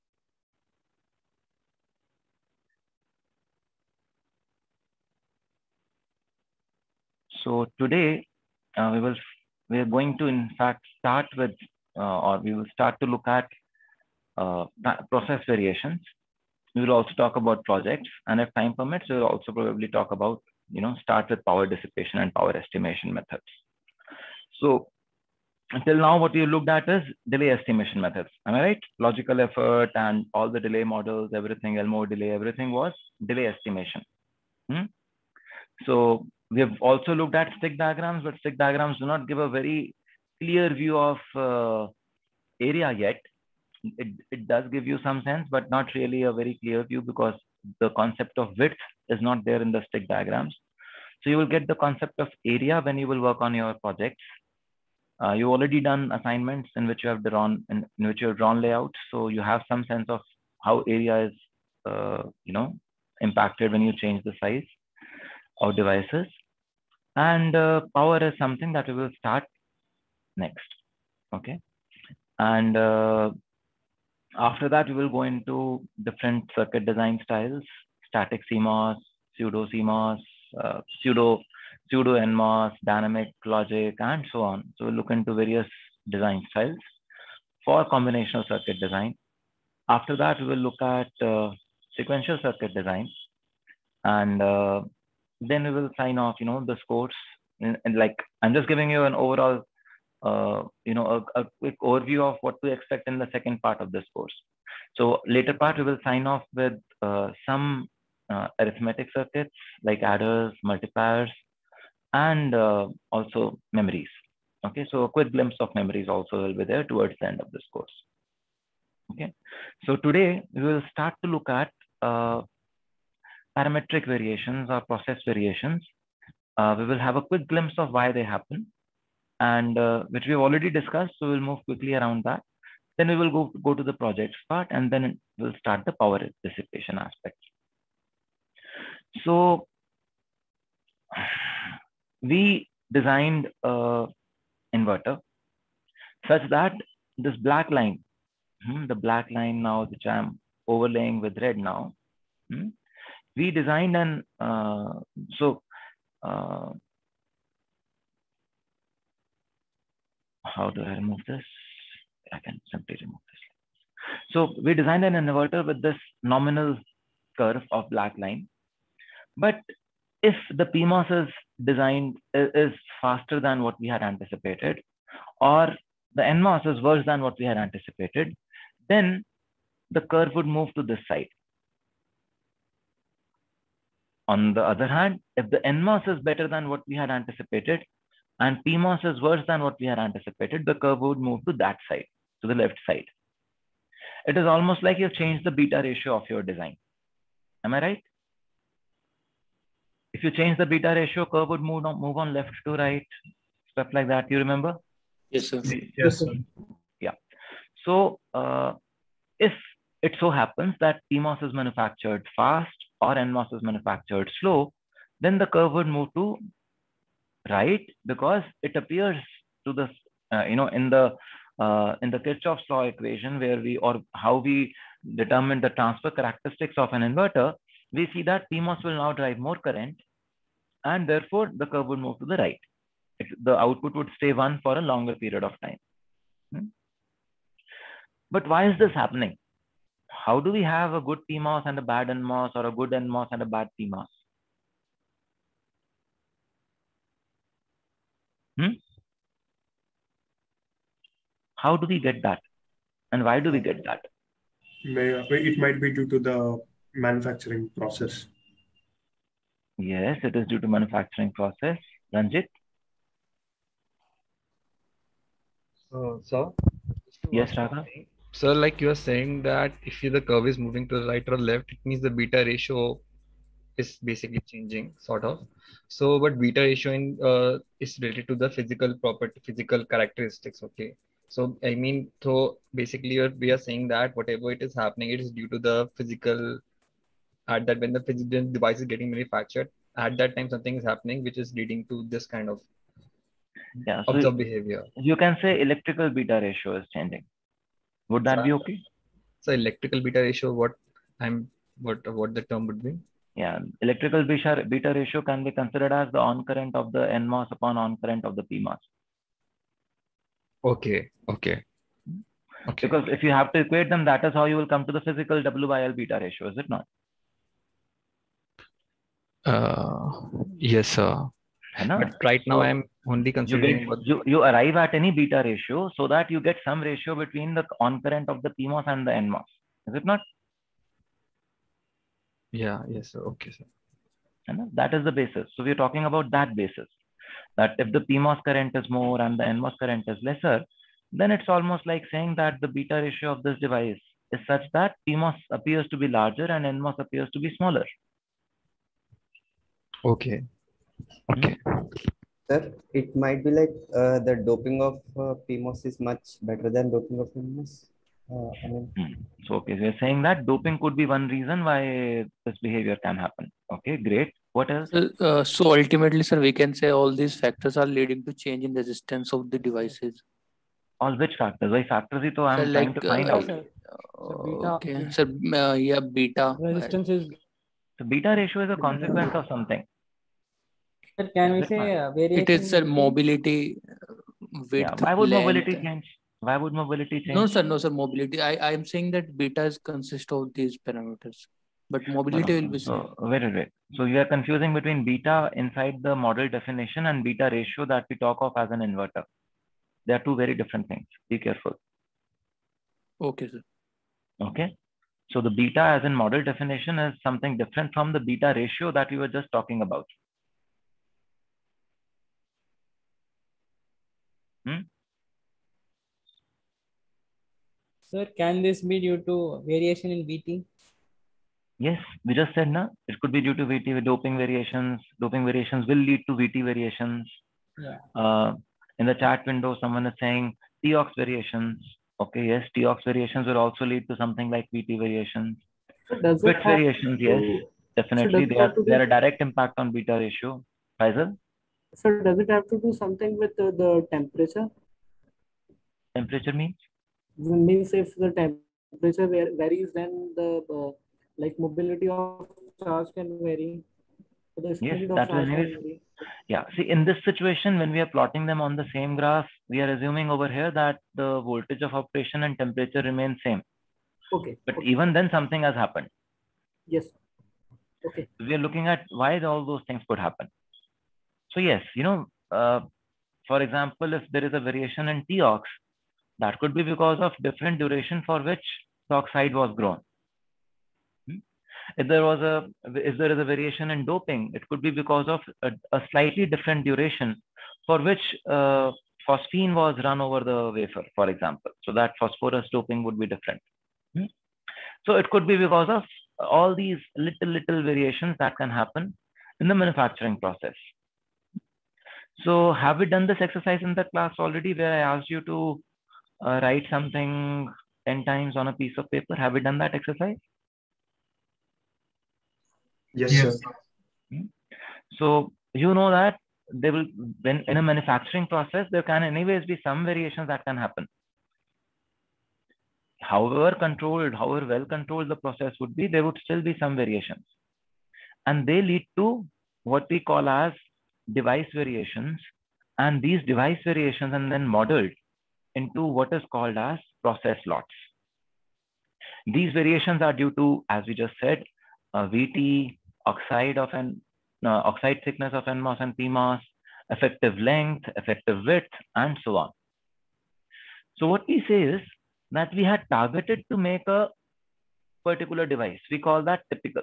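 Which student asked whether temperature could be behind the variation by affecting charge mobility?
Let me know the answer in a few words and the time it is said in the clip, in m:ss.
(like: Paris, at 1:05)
Faisal, at 7:21.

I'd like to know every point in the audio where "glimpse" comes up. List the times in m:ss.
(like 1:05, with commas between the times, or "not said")
1:55, 2:07.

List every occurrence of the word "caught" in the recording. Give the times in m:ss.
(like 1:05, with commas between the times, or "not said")
not said.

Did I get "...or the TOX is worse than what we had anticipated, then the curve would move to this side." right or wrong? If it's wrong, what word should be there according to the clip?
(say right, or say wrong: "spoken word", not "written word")
wrong: "NMOS", not "TOX".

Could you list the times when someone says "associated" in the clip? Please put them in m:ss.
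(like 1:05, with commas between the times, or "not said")
not said.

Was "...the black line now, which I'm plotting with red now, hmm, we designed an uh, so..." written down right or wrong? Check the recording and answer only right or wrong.
wrong.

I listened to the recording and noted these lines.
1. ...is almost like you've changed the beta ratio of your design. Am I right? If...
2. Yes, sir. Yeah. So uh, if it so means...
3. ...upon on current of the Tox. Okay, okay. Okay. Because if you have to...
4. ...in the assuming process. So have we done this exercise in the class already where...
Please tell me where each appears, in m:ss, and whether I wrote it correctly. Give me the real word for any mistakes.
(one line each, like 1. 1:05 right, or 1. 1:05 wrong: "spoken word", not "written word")
1. 3:14 right
2. 3:25 wrong: "happens", not "means"
3. 5:07 wrong: "PMOS", not "Tox"
4. 8:19 wrong: "manufacturing", not "assuming".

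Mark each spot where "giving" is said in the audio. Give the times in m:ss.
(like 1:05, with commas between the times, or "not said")
1:38.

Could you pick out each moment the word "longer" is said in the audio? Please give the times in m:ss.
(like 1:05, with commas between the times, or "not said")
3:54.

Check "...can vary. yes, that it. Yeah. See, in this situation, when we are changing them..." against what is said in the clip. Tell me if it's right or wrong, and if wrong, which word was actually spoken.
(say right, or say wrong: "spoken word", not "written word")
wrong: "plotting", not "changing".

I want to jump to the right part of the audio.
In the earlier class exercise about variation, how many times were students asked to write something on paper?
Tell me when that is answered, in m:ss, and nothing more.
8:28.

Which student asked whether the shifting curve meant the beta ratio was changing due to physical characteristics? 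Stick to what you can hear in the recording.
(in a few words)
Raghav.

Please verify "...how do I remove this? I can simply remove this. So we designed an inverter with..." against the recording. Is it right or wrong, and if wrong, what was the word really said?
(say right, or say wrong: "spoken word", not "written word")
right.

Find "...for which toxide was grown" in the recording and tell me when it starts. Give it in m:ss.
7:58.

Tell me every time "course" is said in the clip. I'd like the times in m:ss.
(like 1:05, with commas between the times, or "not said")
1:44, 1:57.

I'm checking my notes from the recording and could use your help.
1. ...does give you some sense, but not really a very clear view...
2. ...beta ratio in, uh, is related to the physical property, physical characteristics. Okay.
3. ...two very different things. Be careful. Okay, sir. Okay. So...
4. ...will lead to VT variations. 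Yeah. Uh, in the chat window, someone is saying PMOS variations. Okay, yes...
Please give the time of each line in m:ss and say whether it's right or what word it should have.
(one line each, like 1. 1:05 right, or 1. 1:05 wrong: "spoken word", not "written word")
1. 0:44 right
2. 4:36 right
3. 6:40 right
4. 7:05 wrong: "TOX", not "PMOS".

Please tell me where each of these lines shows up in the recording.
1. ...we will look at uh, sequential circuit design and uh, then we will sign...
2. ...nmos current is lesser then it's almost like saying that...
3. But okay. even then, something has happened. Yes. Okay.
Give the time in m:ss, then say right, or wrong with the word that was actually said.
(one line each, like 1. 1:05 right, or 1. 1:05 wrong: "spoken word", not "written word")
1. 1:30 right
2. 5:39 right
3. 7:44 right.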